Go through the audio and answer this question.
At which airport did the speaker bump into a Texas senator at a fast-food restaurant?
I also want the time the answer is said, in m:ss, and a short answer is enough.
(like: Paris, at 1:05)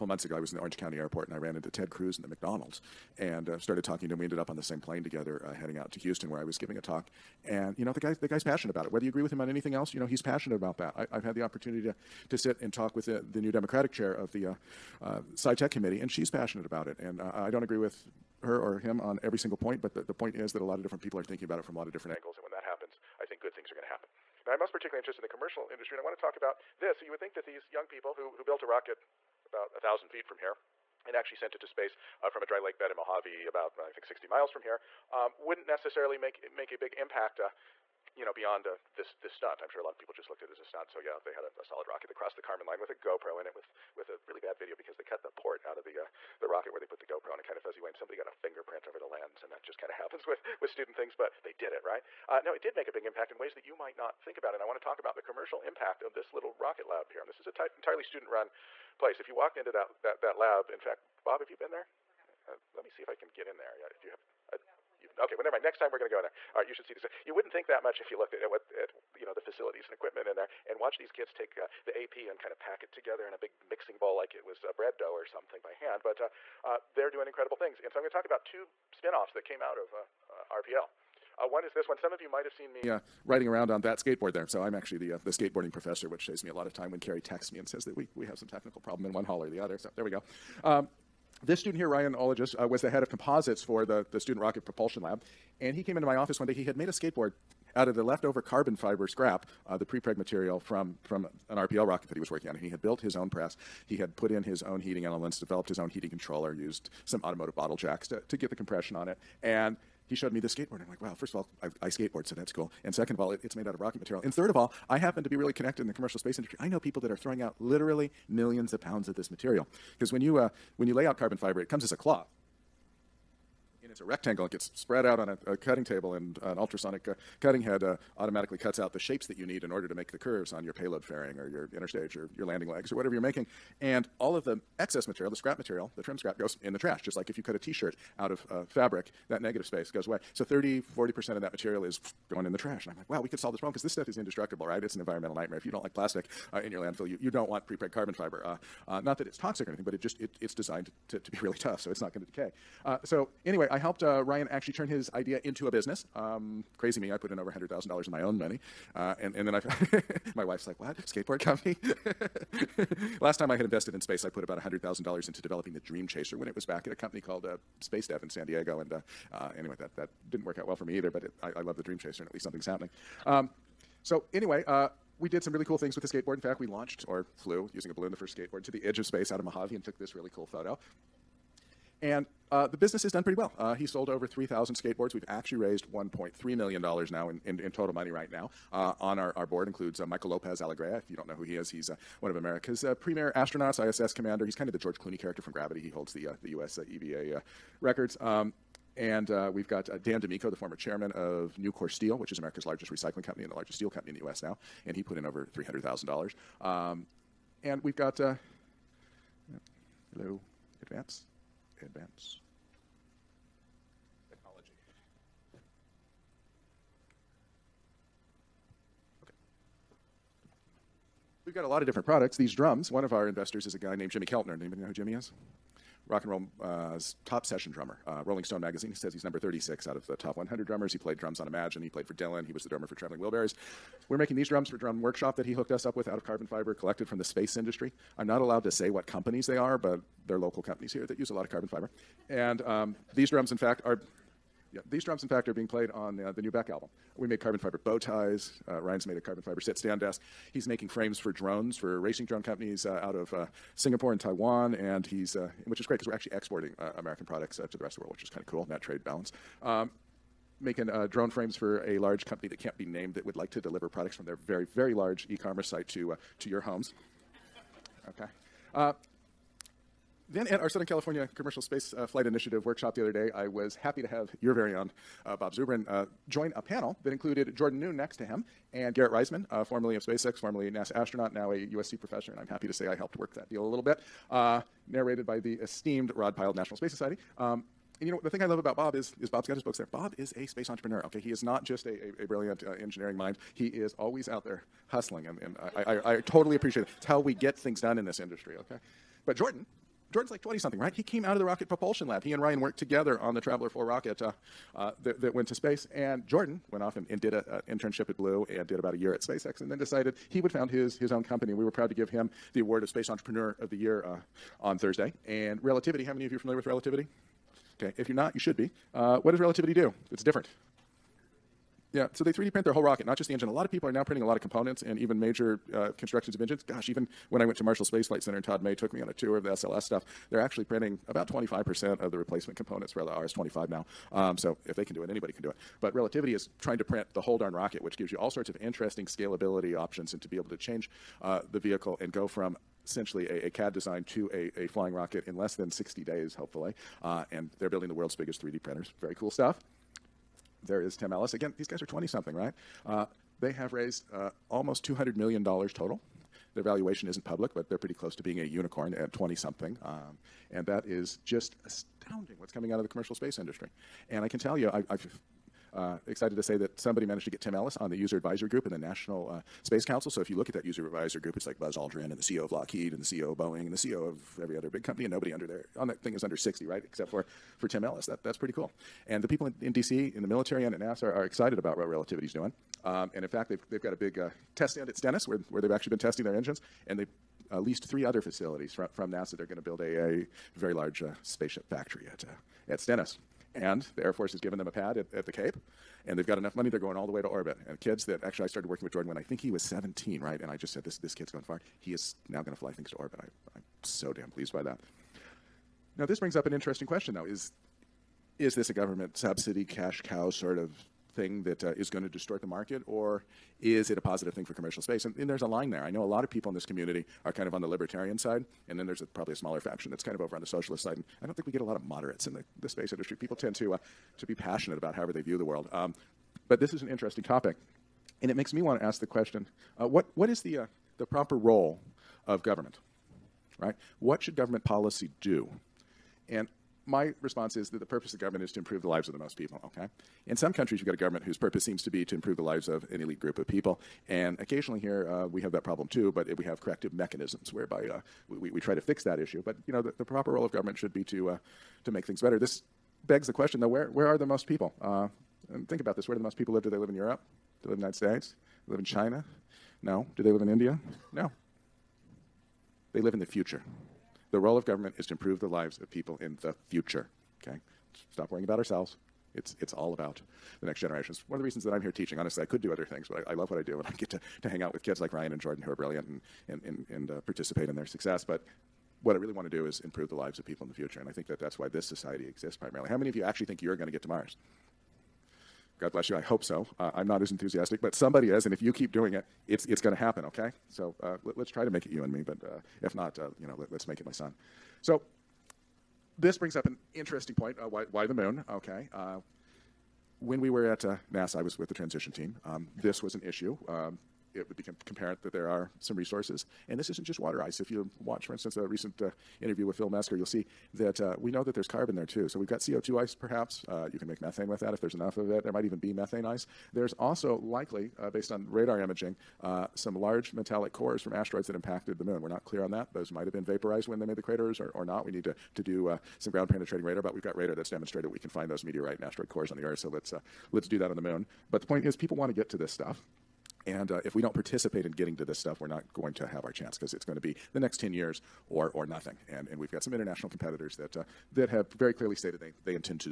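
Orange County airport, at 0:00.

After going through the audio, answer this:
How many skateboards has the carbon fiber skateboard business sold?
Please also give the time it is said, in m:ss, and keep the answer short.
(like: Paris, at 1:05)
3,000, at 3:04.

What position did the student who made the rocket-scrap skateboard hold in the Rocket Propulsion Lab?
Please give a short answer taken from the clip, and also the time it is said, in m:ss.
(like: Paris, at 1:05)
Head of composites, at 1:32.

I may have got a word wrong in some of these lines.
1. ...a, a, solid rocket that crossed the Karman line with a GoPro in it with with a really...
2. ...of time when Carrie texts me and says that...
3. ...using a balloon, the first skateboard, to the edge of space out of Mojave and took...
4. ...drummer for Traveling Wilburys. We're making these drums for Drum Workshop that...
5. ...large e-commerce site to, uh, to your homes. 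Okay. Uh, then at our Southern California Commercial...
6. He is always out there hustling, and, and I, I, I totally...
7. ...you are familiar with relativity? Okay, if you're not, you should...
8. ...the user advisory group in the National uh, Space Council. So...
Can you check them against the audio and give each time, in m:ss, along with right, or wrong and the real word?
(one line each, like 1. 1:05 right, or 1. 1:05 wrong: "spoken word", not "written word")
1. 0:41 right
2. 1:26 right
3. 2:57 right
4. 3:52 right
5. 4:24 right
6. 4:53 right
7. 5:16 right
8. 6:07 right.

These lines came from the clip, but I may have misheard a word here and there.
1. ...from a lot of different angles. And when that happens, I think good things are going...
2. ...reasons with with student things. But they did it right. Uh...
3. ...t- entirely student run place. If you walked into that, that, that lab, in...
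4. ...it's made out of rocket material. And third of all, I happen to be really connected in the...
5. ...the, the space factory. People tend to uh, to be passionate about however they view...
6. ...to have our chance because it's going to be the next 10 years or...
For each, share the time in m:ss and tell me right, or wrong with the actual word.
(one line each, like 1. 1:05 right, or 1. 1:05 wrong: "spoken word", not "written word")
1. 0:21 right
2. 0:49 wrong: "happens", not "reasons"
3. 0:57 right
4. 1:53 right
5. 7:02 wrong: "industry", not "factory"
6. 8:56 right.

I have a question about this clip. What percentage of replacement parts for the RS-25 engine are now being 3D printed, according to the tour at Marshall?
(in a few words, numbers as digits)
25%.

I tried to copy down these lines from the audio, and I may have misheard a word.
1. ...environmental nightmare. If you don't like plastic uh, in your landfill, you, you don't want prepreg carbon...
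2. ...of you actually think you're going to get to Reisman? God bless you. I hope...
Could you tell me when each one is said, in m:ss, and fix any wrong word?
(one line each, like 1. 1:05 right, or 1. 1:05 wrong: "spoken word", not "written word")
1. 2:24 right
2. 8:03 wrong: "Mars", not "Reisman".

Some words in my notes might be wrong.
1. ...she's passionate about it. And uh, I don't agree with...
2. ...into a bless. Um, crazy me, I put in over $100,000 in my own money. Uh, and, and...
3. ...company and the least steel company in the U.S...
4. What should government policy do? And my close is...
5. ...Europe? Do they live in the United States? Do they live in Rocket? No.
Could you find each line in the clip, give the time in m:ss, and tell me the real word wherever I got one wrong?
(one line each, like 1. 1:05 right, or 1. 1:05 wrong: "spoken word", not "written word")
1. 0:16 right
2. 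2:35 wrong: "business", not "bless"
3. 3:23 wrong: "largest", not "least"
4. 7:14 wrong: "response", not "close"
5. 7:36 wrong: "China", not "Rocket".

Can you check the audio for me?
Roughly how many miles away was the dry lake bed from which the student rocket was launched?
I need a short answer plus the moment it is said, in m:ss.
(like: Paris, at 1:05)
60, at 0:34.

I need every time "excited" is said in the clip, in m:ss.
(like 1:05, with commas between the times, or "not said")
6:06, 6:21.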